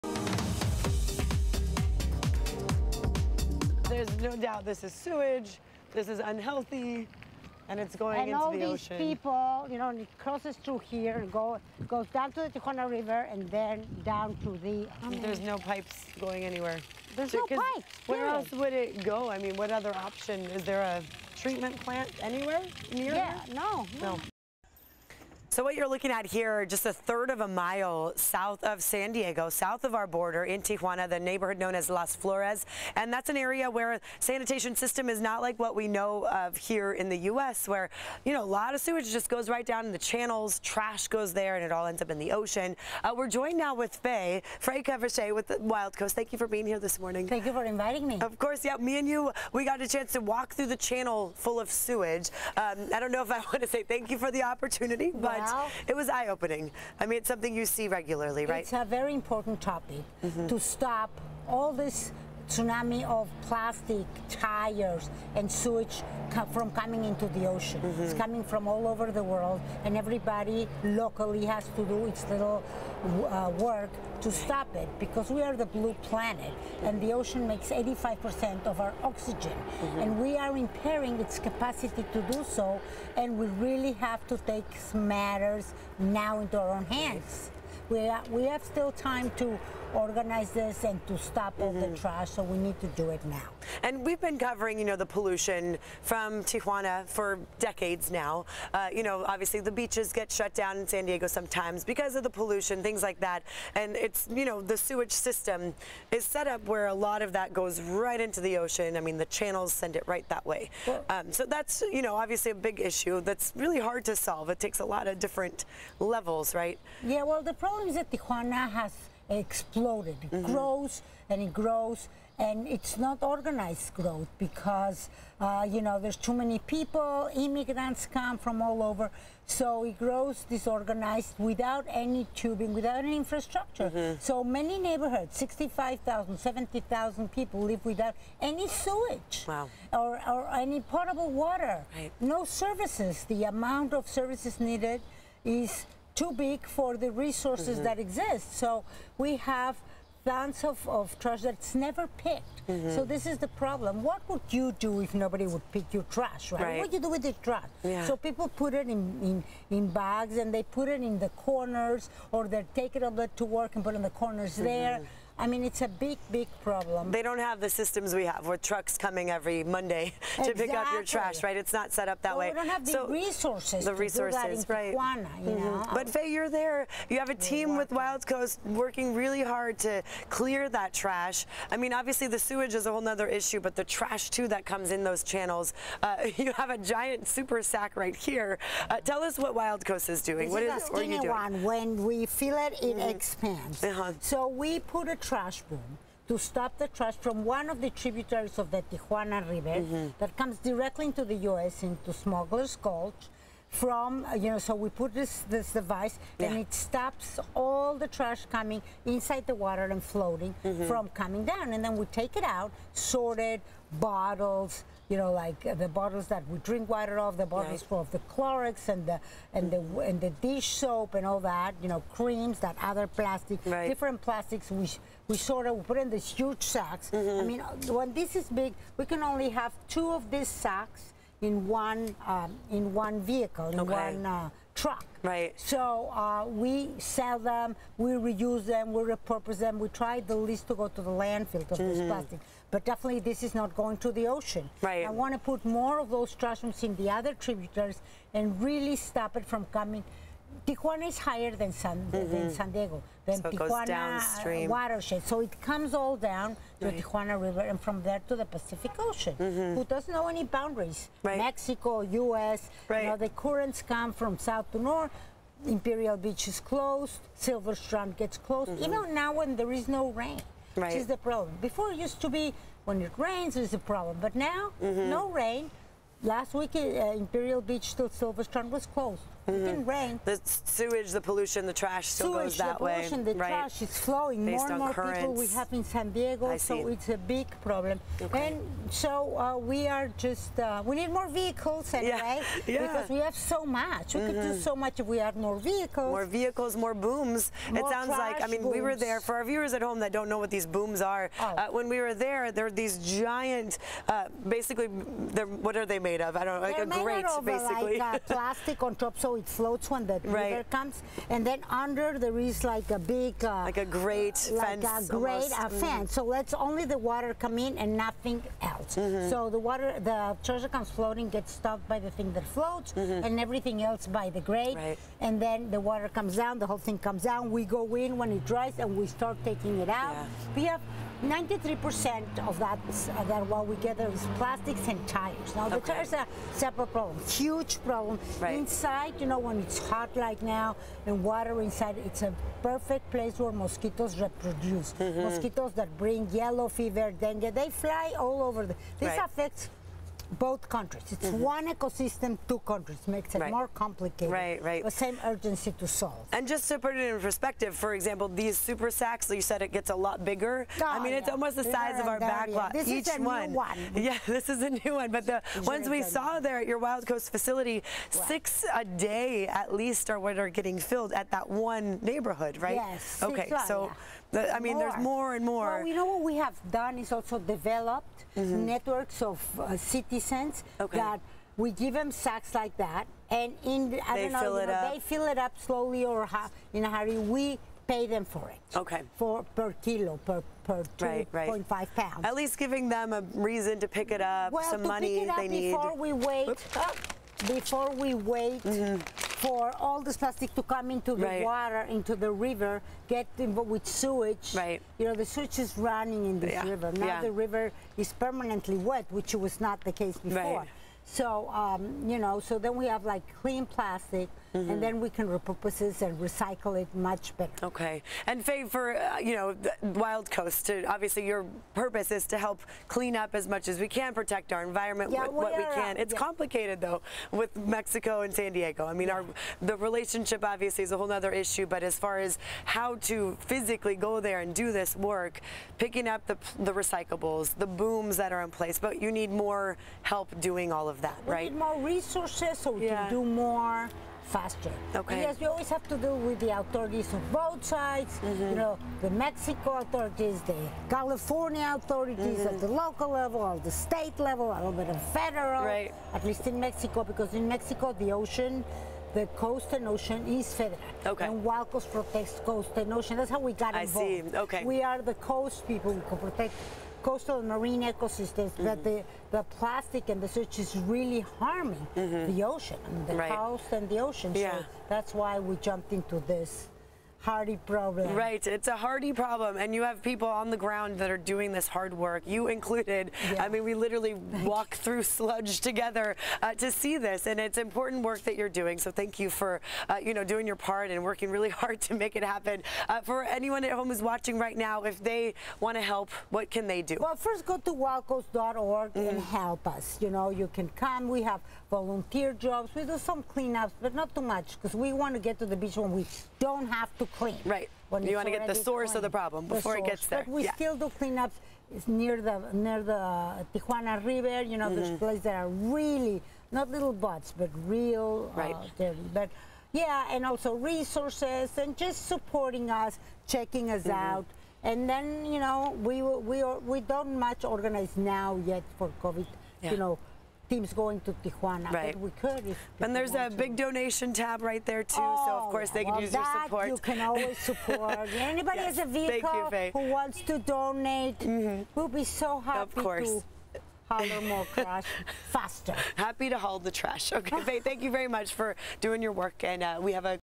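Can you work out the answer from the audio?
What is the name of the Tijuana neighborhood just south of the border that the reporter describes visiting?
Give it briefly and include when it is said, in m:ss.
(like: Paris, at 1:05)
Las Flores, at 0:31.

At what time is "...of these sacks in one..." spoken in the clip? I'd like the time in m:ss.
3:50.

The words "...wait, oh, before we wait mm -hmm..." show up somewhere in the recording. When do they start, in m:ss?
6:36.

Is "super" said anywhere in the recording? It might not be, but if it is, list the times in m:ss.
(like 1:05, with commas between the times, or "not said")
3:07, 5:58.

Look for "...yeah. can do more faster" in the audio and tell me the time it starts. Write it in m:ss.
7:22.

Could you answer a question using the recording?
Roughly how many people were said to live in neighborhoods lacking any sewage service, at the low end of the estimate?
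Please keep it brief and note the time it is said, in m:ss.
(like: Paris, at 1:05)
65000, at 2:15.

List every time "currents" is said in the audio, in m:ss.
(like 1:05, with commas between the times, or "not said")
4:23, 4:44.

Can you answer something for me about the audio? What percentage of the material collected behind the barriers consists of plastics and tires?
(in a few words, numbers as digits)
93%.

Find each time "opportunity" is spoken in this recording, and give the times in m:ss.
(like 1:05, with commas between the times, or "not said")
0:54.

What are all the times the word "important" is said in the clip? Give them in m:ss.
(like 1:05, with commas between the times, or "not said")
0:59, 8:07.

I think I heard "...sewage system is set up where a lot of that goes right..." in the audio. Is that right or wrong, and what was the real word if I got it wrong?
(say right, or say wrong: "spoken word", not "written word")
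right.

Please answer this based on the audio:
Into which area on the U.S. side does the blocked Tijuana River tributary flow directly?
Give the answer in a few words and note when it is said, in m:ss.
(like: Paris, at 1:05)
Smuggler's Gulch, at 3:22.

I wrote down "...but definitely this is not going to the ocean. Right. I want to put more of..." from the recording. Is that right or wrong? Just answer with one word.
right.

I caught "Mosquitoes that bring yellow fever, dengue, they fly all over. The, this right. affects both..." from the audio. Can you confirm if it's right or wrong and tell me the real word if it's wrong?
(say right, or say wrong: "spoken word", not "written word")
right.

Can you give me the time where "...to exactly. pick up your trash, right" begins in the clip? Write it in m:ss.
2:50.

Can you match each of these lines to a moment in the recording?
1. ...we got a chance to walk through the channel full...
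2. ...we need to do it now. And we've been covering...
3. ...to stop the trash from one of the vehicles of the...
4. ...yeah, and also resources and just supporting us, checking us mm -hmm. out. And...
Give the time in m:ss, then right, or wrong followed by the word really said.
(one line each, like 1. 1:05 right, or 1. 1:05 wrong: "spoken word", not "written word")
1. 0:49 right
2. 1:32 right
3. 3:16 wrong: "tributaries", not "vehicles"
4. 8:39 right.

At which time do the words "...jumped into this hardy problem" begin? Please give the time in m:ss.
7:55.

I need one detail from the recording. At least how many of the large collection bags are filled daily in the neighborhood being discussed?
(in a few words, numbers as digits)
6.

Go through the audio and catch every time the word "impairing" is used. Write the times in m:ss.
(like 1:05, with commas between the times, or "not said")
1:20.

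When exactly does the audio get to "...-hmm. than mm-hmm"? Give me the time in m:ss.
4:12.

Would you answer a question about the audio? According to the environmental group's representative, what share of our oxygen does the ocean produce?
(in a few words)
85%.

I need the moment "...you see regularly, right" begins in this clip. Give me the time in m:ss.
0:57.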